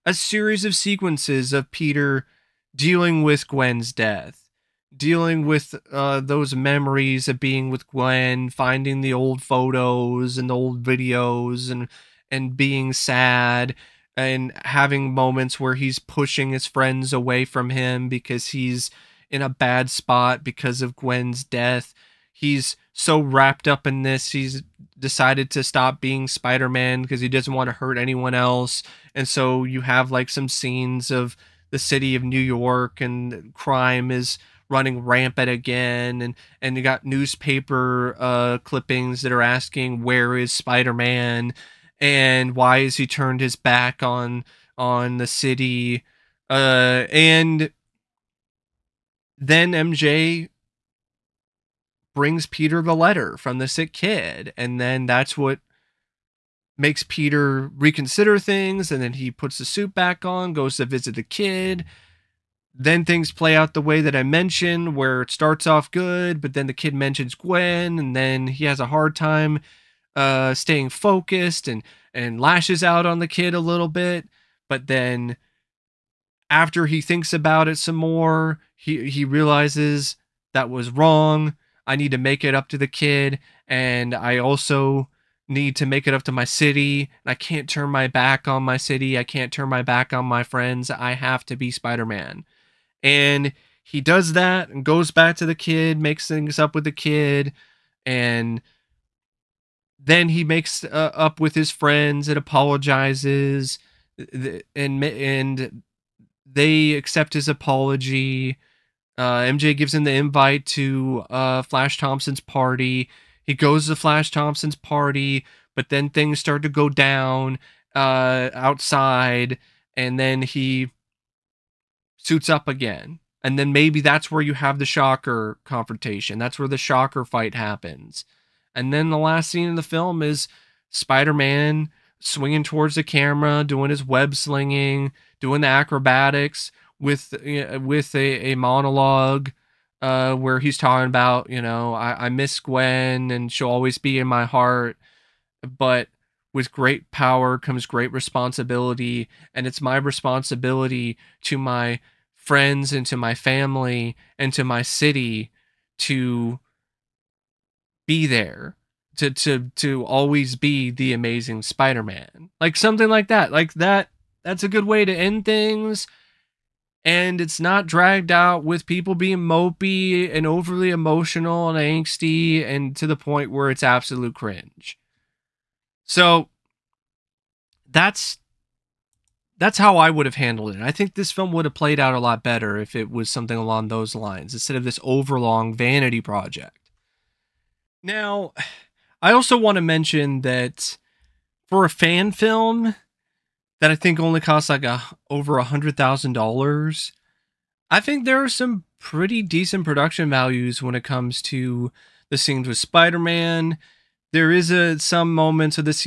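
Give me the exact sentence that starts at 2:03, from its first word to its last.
And then maybe that's where you have the shocker confrontation.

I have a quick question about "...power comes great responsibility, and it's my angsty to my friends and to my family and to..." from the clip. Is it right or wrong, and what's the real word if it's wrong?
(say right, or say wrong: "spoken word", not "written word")
wrong: "responsibility", not "angsty".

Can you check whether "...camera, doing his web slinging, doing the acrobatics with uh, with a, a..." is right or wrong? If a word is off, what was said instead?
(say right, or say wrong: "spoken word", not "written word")
right.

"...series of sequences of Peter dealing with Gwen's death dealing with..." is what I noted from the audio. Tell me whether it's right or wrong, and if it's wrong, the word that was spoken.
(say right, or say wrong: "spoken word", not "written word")
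right.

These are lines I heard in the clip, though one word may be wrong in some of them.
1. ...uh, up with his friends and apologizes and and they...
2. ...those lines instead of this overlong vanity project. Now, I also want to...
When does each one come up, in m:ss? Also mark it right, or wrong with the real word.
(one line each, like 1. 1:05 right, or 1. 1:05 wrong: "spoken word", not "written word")
1. 1:40 right
2. 3:03 right.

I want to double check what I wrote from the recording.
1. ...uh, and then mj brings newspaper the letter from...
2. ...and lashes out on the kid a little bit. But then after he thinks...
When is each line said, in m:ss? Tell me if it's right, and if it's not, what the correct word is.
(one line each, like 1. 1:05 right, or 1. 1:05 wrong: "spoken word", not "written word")
1. 0:46 wrong: "peter", not "newspaper"
2. 1:12 right.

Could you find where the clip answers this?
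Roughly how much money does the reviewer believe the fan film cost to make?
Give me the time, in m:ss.
3:15.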